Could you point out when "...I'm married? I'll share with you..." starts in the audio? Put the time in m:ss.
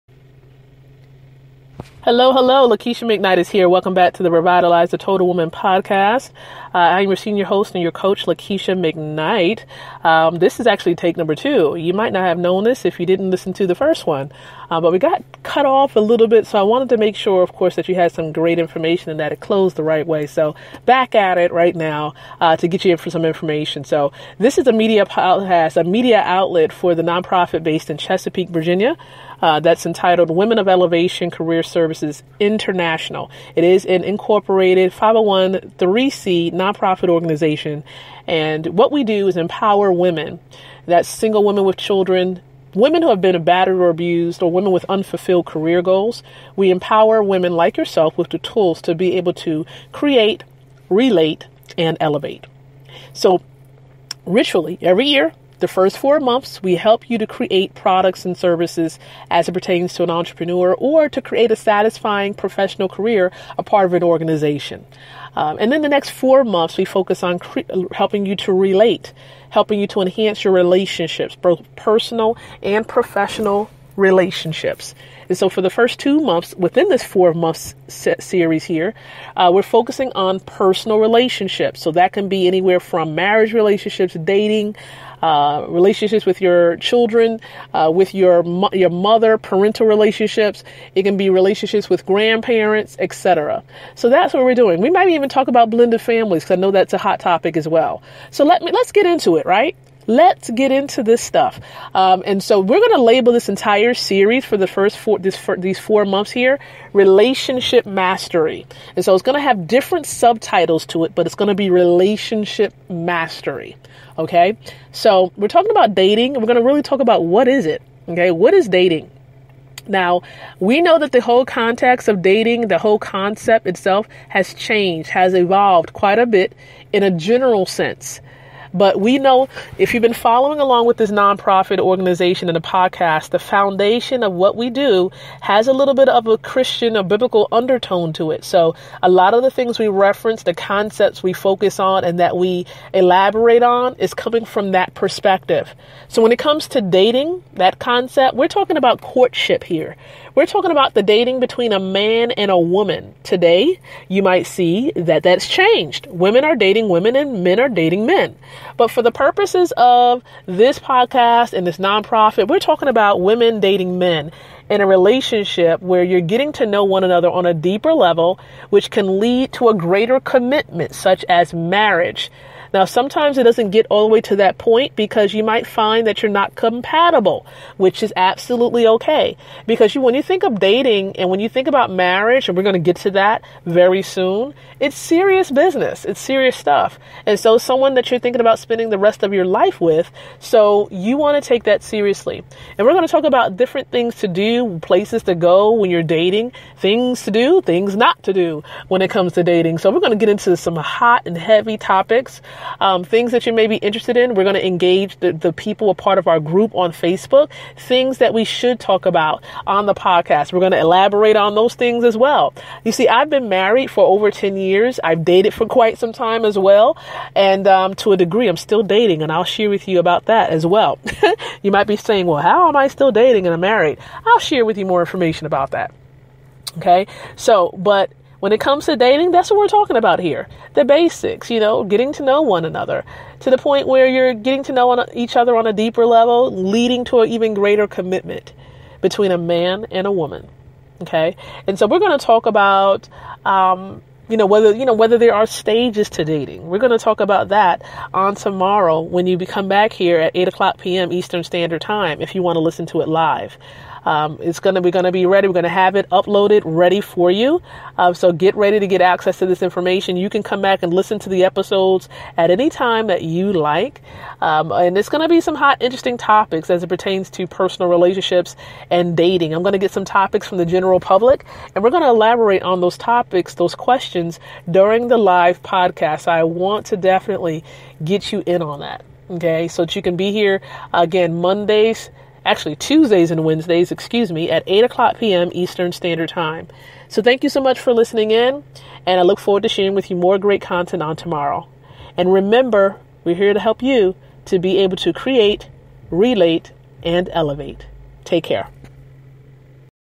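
3:43.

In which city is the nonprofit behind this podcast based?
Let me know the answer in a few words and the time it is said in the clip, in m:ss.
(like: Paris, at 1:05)
Chesapeake, Virginia, at 0:27.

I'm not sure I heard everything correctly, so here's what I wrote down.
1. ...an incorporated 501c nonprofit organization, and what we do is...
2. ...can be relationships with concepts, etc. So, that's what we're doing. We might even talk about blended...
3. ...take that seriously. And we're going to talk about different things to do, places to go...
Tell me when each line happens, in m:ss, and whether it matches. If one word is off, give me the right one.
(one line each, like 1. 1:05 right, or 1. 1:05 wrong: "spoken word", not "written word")
1. 0:33 right
2. 1:31 wrong: "grandparents", not "concepts"
3. 3:11 right.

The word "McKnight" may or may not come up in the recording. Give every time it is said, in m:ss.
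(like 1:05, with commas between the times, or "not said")
0:03, 0:08.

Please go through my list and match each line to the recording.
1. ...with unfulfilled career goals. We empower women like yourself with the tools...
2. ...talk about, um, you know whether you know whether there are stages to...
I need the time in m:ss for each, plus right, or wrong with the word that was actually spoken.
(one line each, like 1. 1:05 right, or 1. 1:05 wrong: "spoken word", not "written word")
1. 0:44 right
2. 4:02 right.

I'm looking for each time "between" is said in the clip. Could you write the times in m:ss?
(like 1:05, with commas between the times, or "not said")
2:31, 3:58.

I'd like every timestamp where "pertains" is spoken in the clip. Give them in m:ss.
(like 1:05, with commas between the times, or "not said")
0:59, 4:26.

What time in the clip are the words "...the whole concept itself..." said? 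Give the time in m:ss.
2:02.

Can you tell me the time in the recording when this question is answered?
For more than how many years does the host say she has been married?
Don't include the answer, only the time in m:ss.
3:34.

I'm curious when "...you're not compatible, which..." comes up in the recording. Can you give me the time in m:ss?
2:56.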